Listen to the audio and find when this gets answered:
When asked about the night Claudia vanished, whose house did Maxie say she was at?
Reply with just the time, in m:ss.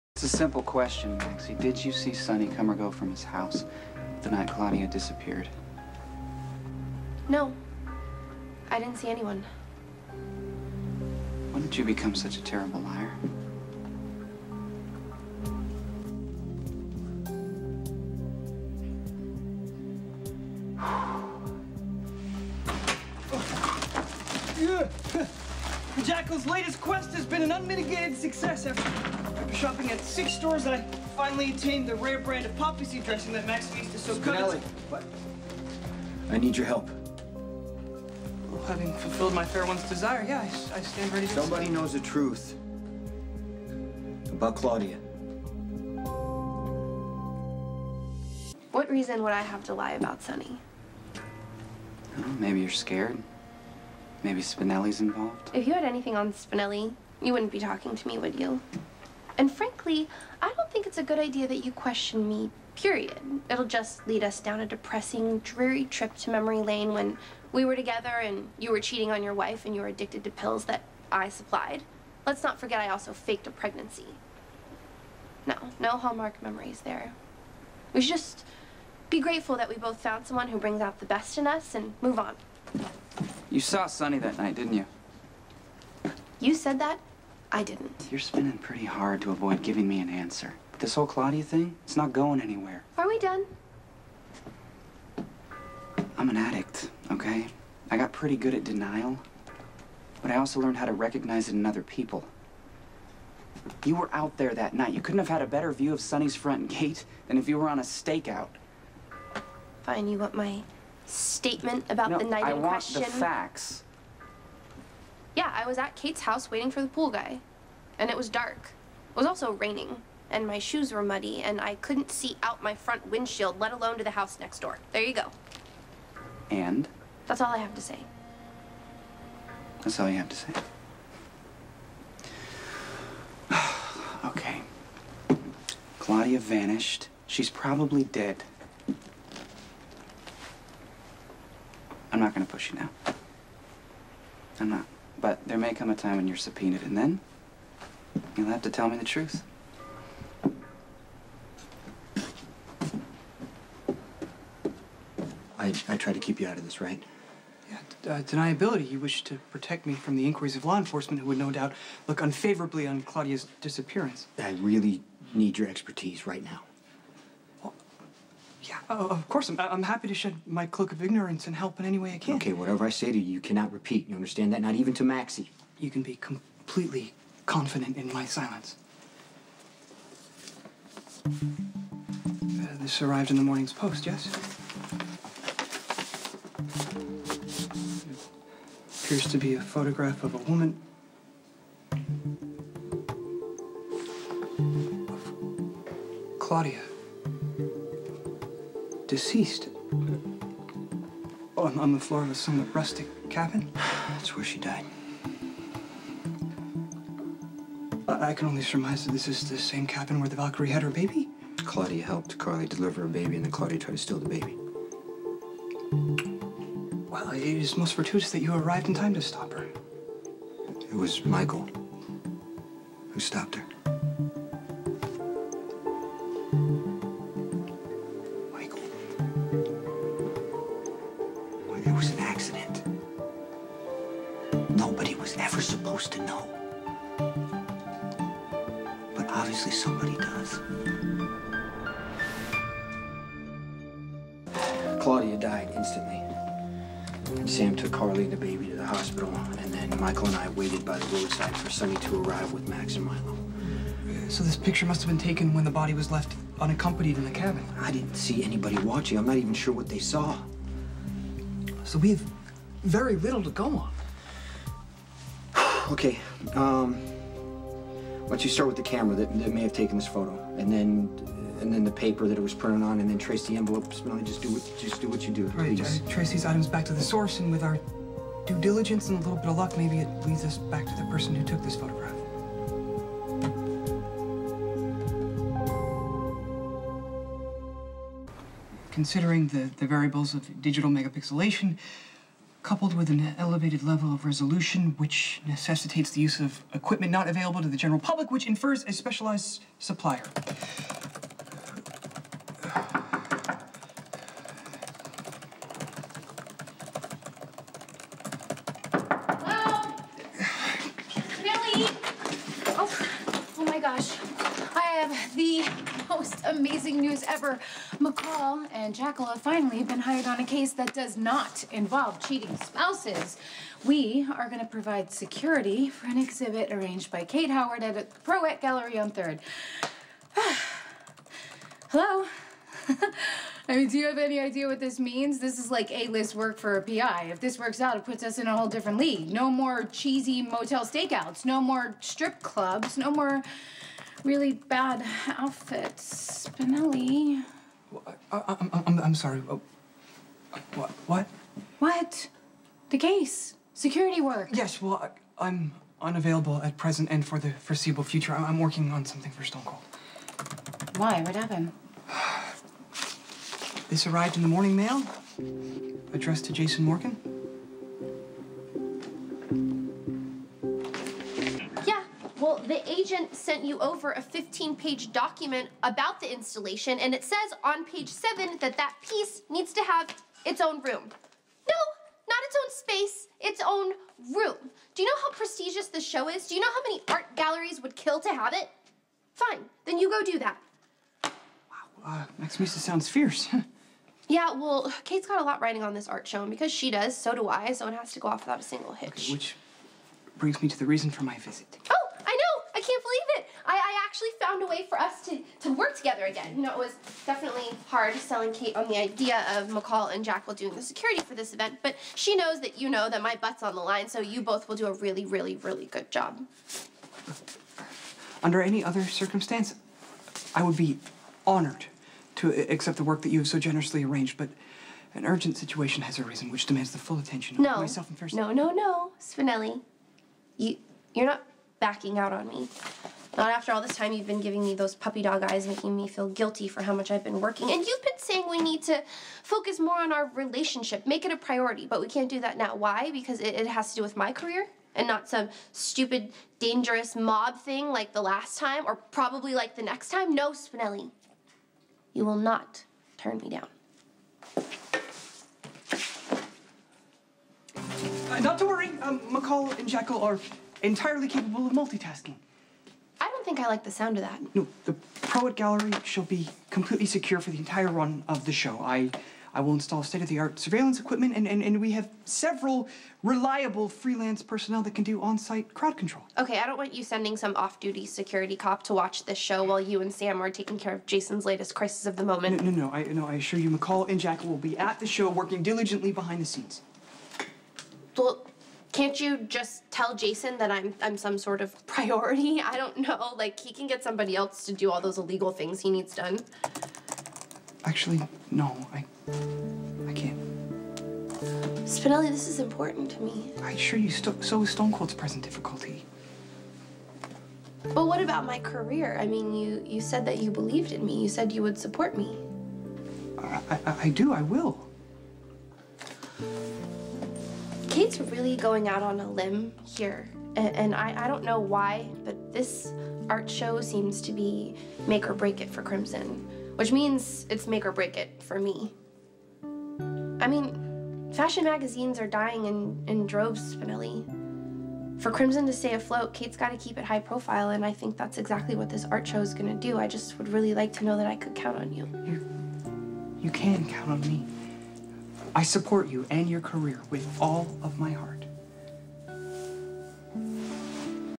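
1:55.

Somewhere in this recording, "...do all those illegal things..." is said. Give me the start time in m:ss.
8:14.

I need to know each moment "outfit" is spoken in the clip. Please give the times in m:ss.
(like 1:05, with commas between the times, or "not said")
5:45.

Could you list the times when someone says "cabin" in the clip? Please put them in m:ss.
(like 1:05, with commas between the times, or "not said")
3:23, 3:29, 4:17.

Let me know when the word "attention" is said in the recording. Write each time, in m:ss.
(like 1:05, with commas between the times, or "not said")
7:07.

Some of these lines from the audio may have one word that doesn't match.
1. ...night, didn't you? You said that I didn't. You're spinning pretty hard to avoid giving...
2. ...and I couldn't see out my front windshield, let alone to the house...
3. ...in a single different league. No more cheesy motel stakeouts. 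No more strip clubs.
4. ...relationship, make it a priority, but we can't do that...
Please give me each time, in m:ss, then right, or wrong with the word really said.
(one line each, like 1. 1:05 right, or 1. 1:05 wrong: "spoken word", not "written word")
1. 1:24 right
2. 2:01 right
3. 5:38 wrong: "whole", not "single"
4. 7:20 right.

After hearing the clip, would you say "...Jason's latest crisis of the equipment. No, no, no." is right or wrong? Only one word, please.
wrong.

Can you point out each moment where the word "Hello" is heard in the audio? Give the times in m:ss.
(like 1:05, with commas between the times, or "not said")
5:09, 5:31.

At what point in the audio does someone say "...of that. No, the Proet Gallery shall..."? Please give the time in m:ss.
7:44.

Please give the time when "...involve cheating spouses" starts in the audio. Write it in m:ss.
5:21.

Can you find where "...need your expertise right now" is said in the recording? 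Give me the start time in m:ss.
2:45.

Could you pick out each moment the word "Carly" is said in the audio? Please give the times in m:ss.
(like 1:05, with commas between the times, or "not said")
3:32, 4:07.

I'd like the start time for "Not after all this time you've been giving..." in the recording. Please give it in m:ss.
7:13.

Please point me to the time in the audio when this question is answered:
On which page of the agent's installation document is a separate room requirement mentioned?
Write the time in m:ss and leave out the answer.
6:17.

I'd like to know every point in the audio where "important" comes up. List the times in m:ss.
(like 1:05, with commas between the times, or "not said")
8:22.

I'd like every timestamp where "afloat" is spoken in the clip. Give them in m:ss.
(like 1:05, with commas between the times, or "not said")
8:55.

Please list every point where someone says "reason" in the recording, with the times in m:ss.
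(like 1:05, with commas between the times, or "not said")
0:48, 6:40.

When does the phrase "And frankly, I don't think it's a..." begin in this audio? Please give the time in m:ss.
0:59.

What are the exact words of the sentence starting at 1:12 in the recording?
Let's not forget I also faked a pregnancy.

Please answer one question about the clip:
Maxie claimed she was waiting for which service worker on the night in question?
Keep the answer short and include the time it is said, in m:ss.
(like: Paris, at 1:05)
The pool guy, at 1:56.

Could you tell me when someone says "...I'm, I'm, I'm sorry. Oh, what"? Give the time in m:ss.
5:48.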